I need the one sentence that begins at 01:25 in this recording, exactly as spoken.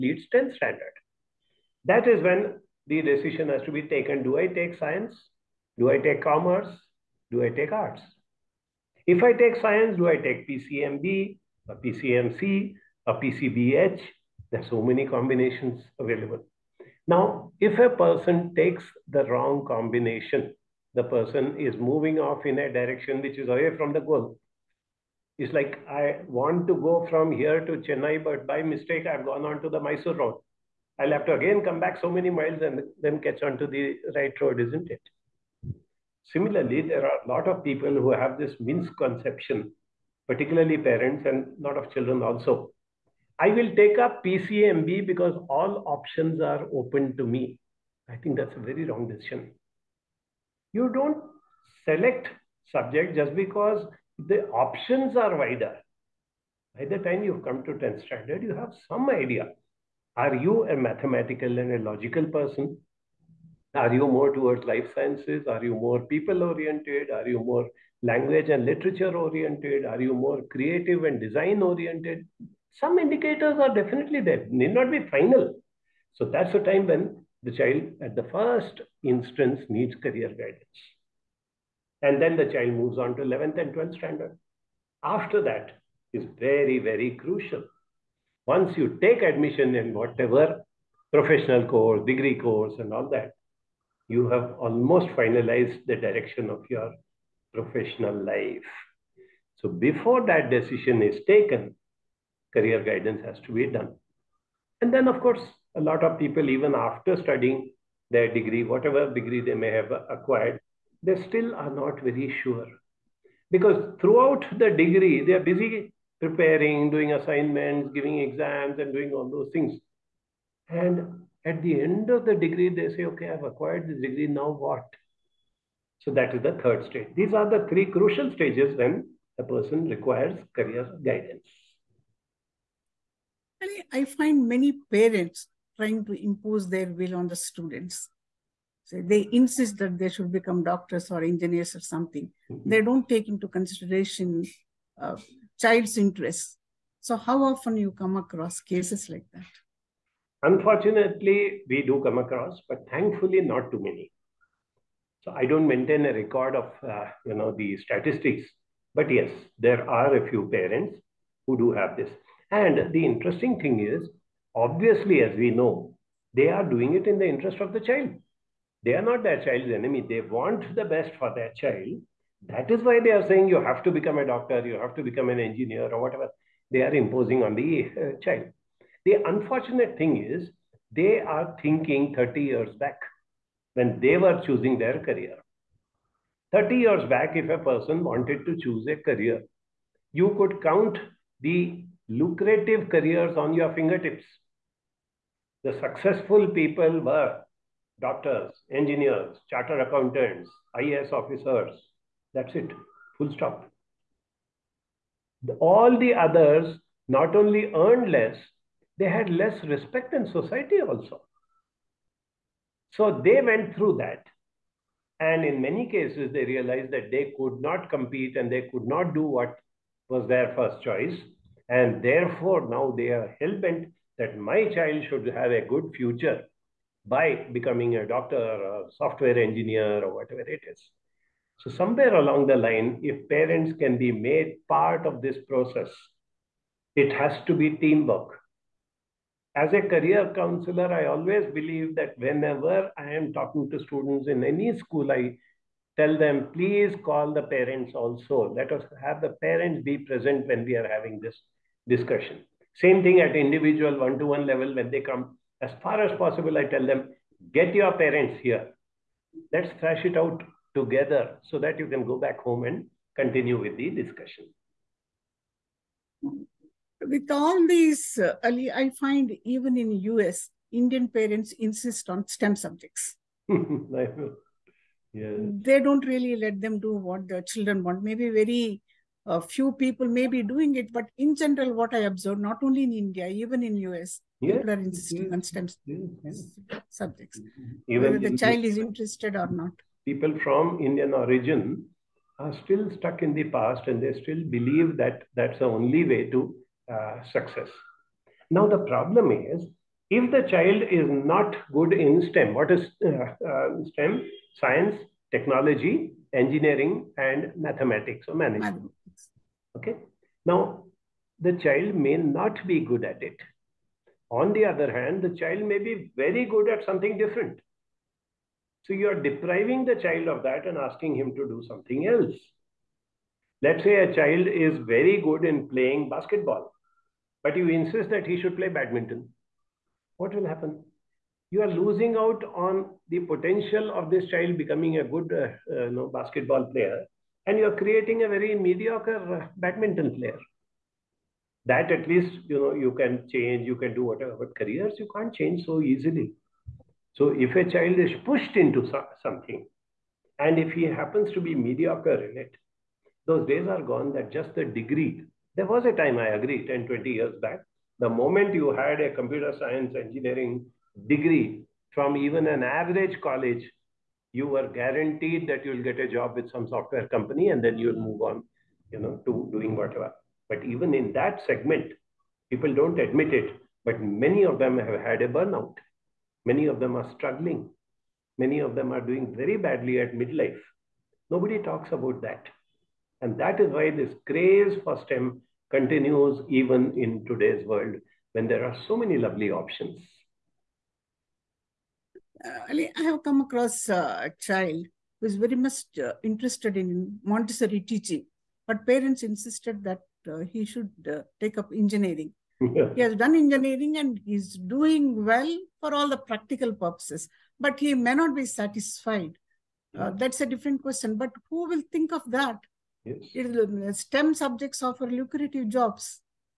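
After that is very, very crucial.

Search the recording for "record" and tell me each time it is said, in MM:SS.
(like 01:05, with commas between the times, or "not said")
02:36.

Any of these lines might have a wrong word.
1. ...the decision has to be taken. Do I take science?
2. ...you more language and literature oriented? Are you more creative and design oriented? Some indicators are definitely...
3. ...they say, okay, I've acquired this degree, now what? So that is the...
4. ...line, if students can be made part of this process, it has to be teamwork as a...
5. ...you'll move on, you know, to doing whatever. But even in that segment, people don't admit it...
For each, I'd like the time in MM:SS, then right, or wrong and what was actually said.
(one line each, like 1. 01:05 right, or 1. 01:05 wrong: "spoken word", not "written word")
1. 00:02 right
2. 01:07 right
3. 02:02 right
4. 03:52 wrong: "parents", not "students"
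5. 06:07 right.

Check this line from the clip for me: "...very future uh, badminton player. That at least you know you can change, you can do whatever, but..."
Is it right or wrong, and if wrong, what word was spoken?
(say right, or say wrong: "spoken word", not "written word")
wrong: "mediocre", not "future".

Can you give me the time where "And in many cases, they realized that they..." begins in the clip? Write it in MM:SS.
03:35.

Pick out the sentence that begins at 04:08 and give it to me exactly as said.
Let us have the parents be present when we are having this discussion.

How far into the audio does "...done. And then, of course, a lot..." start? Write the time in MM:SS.
01:43.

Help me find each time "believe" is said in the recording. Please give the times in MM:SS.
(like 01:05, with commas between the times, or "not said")
04:01, 04:54.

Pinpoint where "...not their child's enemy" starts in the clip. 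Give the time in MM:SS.
02:49.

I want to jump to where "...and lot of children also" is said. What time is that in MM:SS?
00:41.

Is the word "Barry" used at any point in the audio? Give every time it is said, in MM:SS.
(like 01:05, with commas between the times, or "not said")
not said.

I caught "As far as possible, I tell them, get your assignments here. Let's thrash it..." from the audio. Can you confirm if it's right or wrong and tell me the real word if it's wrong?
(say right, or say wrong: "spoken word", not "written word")
wrong: "parents", not "assignments".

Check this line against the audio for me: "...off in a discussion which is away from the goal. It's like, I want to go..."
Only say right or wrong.
wrong.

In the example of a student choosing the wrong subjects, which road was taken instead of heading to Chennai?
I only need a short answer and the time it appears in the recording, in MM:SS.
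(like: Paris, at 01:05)
Mysore road, at 00:29.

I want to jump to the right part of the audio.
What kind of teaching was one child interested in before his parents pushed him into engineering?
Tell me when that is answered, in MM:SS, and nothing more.
06:37.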